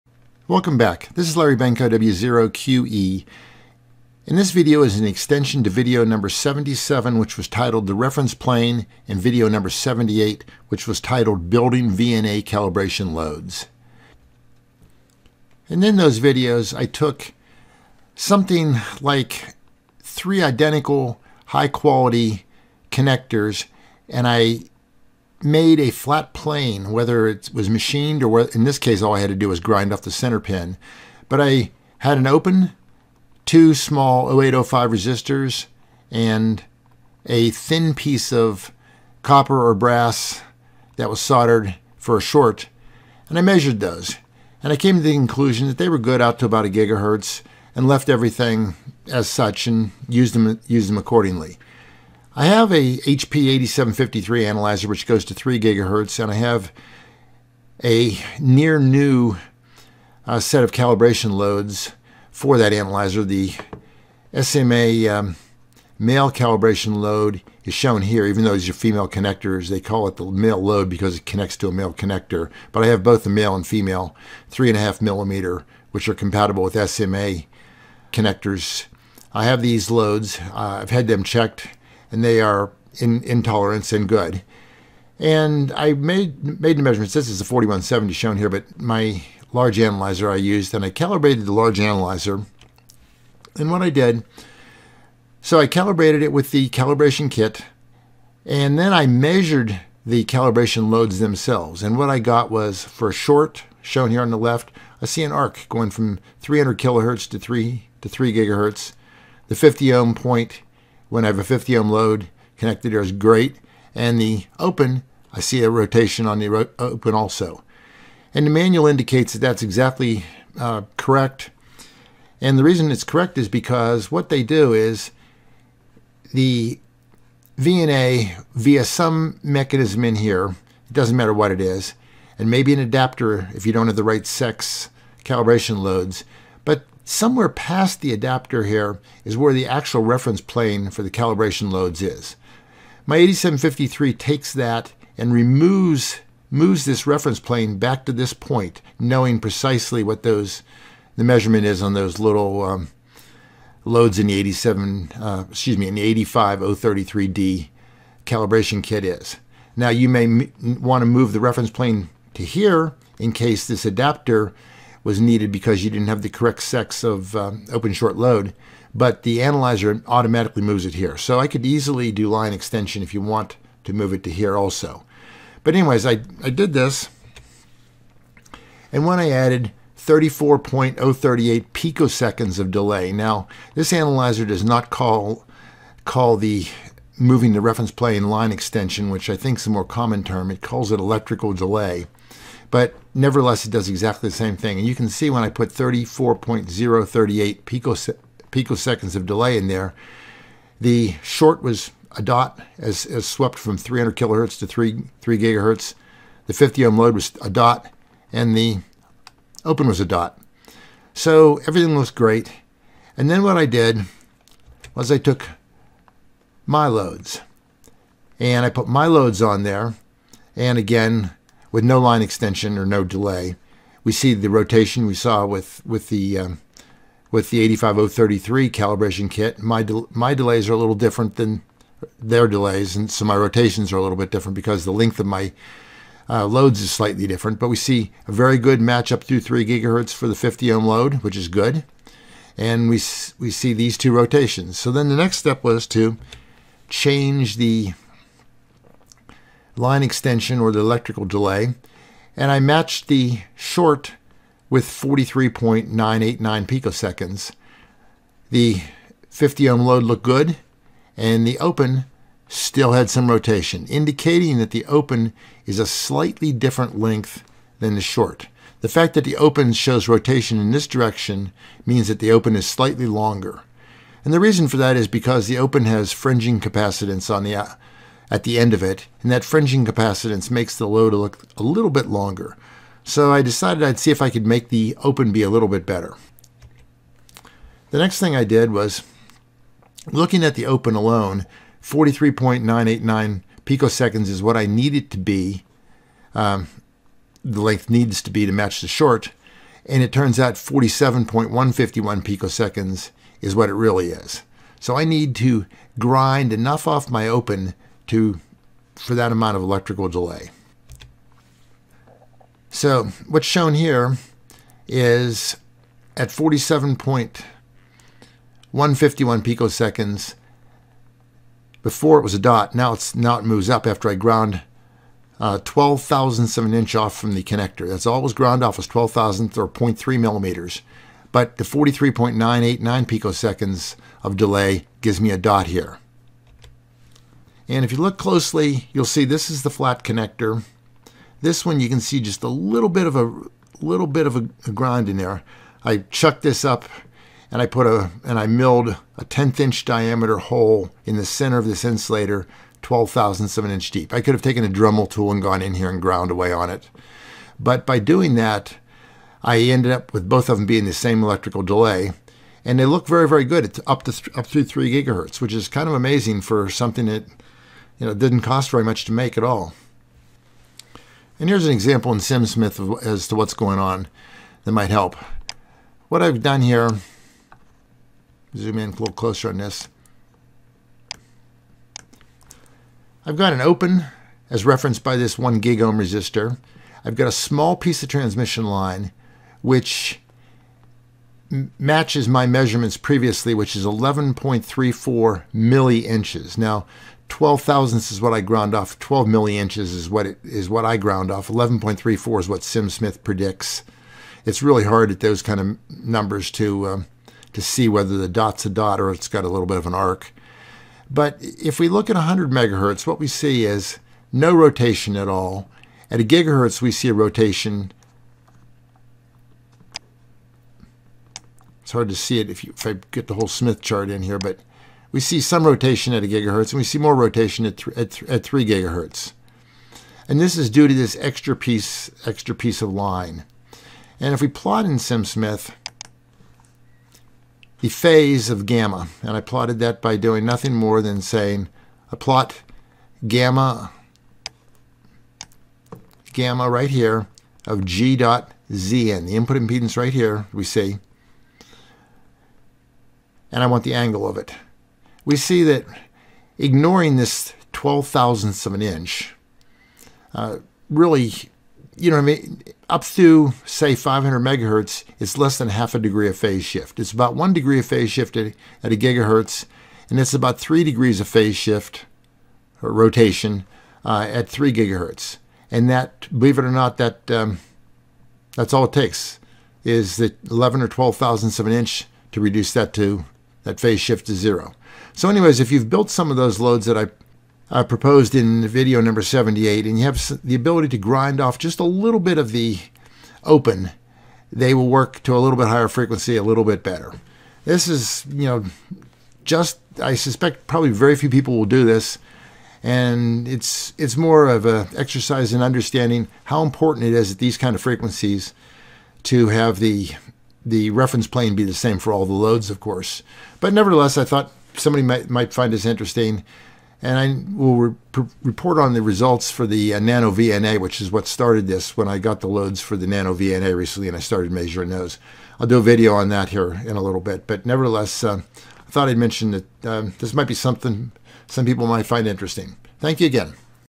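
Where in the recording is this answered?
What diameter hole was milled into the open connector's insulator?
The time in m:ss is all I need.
5:49.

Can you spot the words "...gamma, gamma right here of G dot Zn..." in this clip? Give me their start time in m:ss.
7:23.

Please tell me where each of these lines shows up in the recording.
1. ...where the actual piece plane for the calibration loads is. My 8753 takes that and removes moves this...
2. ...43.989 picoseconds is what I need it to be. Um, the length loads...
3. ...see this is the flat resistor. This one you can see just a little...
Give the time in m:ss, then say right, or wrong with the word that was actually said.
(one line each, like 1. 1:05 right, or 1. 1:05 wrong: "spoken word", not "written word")
1. 2:19 wrong: "reference", not "piece"
2. 4:51 wrong: "needs", not "loads"
3. 5:39 wrong: "connector", not "resistor".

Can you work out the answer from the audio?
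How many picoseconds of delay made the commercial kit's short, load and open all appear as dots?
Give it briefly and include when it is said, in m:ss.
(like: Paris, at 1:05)
34.038 picoseconds, at 2:59.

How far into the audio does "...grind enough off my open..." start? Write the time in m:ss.
5:05.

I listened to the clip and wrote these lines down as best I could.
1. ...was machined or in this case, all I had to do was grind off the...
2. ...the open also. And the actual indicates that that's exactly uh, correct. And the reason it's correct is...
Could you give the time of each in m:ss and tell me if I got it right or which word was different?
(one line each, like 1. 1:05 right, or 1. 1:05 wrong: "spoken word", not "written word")
1. 0:27 right
2. 1:56 wrong: "manual", not "actual".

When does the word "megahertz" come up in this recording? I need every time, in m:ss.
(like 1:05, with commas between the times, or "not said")
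6:52, 7:44.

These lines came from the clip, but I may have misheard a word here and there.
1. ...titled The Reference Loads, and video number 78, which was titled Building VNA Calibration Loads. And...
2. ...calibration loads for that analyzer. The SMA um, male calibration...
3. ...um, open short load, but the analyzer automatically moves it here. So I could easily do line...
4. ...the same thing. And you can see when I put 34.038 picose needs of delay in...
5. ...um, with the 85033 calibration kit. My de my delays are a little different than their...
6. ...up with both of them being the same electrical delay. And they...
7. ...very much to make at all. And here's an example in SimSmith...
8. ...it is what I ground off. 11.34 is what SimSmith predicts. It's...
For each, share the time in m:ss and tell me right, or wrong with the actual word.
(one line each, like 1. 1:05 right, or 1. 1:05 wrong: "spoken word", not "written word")
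1. 0:07 wrong: "Plane", not "Loads"
2. 1:00 right
3. 2:47 right
4. 3:14 wrong: "picoseconds", not "needs"
5. 3:46 right
6. 5:59 right
7. 6:08 right
8. 6:40 right.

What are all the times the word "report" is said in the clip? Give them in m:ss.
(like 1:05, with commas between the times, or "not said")
8:38.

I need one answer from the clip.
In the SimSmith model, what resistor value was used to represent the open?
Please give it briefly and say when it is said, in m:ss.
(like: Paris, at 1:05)
1 gigohm, at 6:25.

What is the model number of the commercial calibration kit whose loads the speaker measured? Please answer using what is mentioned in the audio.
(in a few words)
85033D.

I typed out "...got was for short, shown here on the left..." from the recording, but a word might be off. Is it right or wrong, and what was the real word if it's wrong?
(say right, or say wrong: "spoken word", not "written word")
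right.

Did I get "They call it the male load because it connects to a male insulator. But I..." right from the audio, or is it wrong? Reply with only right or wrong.
wrong.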